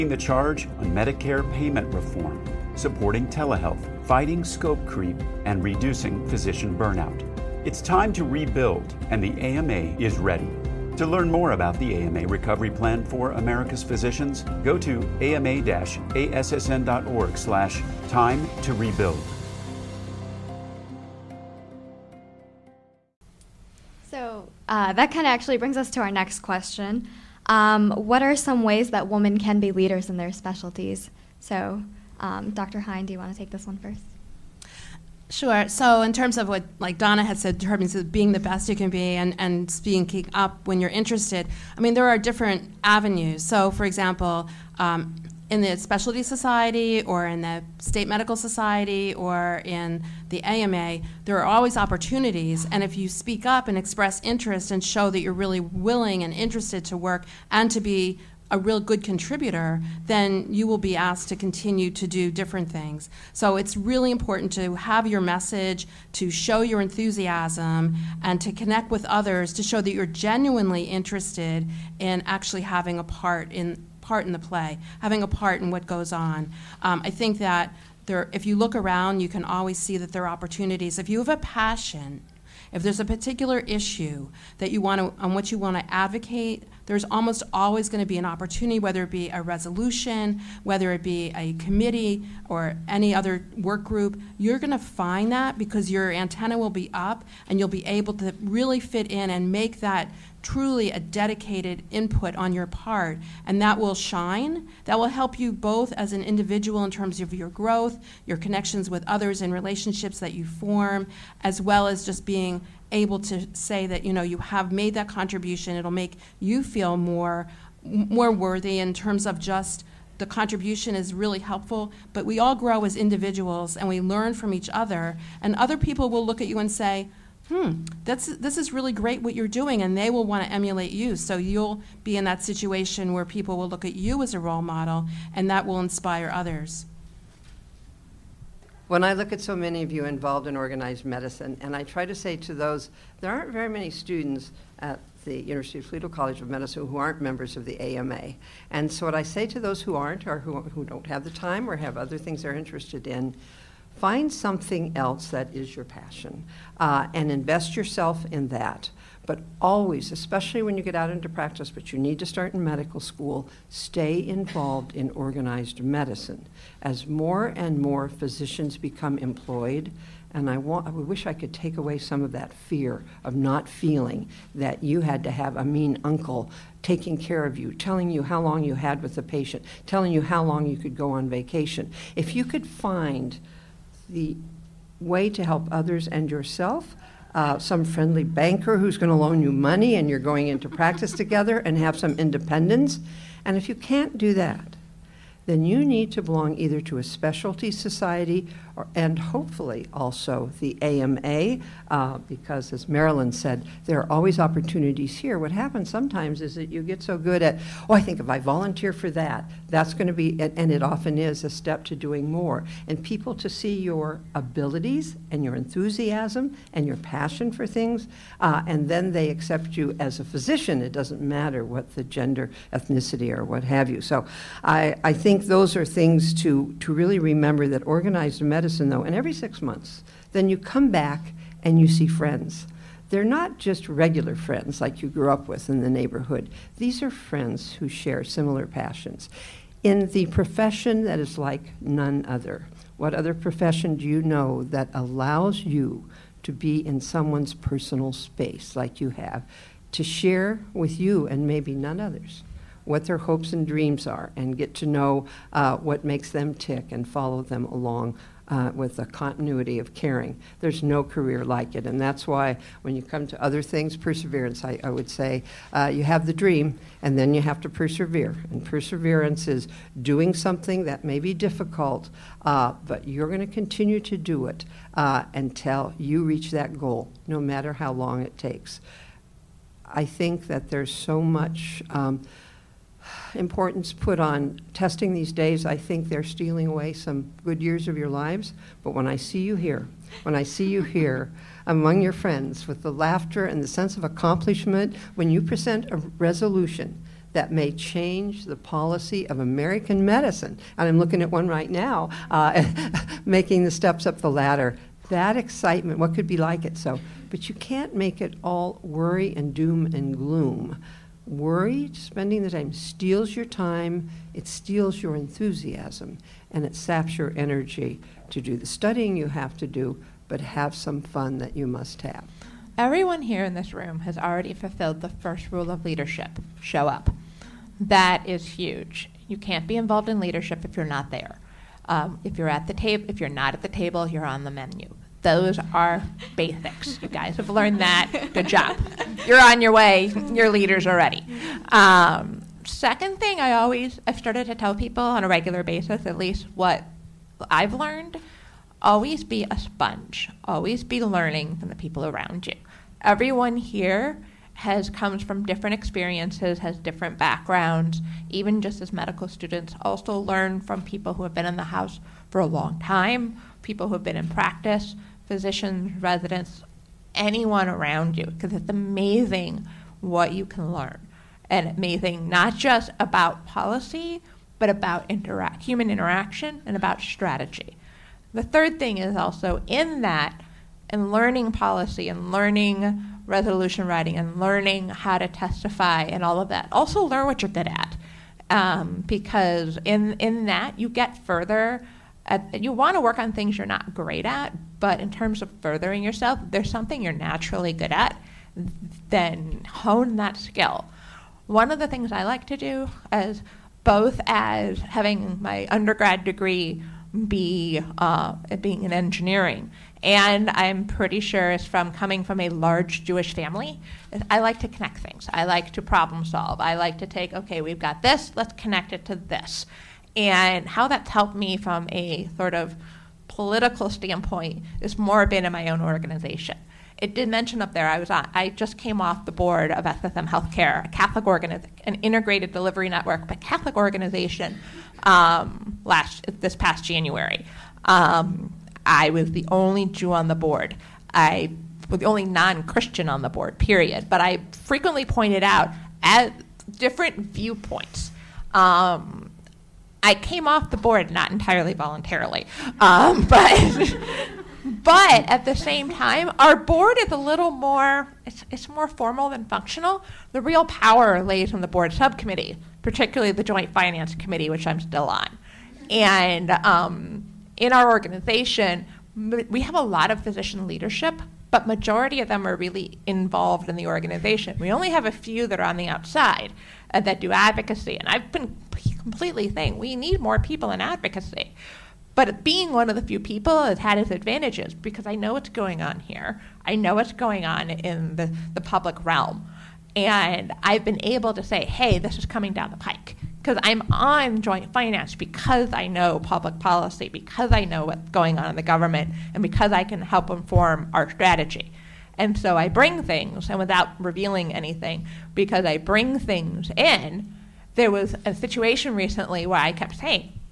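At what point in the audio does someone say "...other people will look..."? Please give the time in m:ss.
2:05.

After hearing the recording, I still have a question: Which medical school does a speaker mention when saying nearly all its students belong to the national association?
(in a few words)
University of Toledo College of Medicine.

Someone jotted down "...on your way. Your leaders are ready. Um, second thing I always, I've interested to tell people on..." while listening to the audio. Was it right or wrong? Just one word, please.
wrong.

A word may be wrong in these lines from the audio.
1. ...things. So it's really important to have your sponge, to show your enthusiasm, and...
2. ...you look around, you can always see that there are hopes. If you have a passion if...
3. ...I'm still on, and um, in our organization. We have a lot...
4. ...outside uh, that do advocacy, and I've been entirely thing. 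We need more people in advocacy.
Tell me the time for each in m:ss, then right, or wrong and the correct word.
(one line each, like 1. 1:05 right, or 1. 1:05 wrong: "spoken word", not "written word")
1. 1:02 wrong: "message", not "sponge"
2. 1:18 wrong: "opportunities", not "hopes"
3. 7:44 right
4. 7:55 wrong: "completely", not "entirely".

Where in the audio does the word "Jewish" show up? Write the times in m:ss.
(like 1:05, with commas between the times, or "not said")
6:53.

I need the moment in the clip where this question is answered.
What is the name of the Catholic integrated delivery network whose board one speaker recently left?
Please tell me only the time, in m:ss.
7:09.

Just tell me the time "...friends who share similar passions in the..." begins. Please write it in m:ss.
3:57.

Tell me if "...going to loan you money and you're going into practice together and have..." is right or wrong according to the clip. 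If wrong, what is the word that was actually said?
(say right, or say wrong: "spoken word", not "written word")
right.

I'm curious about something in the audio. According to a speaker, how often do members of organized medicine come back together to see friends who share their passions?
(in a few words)
Every six months.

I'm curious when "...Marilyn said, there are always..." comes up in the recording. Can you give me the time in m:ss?
3:22.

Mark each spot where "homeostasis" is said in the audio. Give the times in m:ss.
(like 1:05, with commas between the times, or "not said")
not said.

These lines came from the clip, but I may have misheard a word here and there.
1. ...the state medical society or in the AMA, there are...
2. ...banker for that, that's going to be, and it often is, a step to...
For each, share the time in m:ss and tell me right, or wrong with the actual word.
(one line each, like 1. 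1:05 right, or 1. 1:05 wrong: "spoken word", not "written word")
1. 0:47 right
2. 3:28 wrong: "volunteer", not "banker".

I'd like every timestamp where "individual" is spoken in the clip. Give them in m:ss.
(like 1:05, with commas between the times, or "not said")
1:46, 2:02.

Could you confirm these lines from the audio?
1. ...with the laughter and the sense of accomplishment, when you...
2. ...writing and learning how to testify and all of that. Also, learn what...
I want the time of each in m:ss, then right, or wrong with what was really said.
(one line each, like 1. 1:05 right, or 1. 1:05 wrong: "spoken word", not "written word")
1. 4:52 right
2. 6:23 right.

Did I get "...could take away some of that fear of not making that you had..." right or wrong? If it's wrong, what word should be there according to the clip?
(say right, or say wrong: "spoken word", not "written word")
wrong: "feeling", not "making".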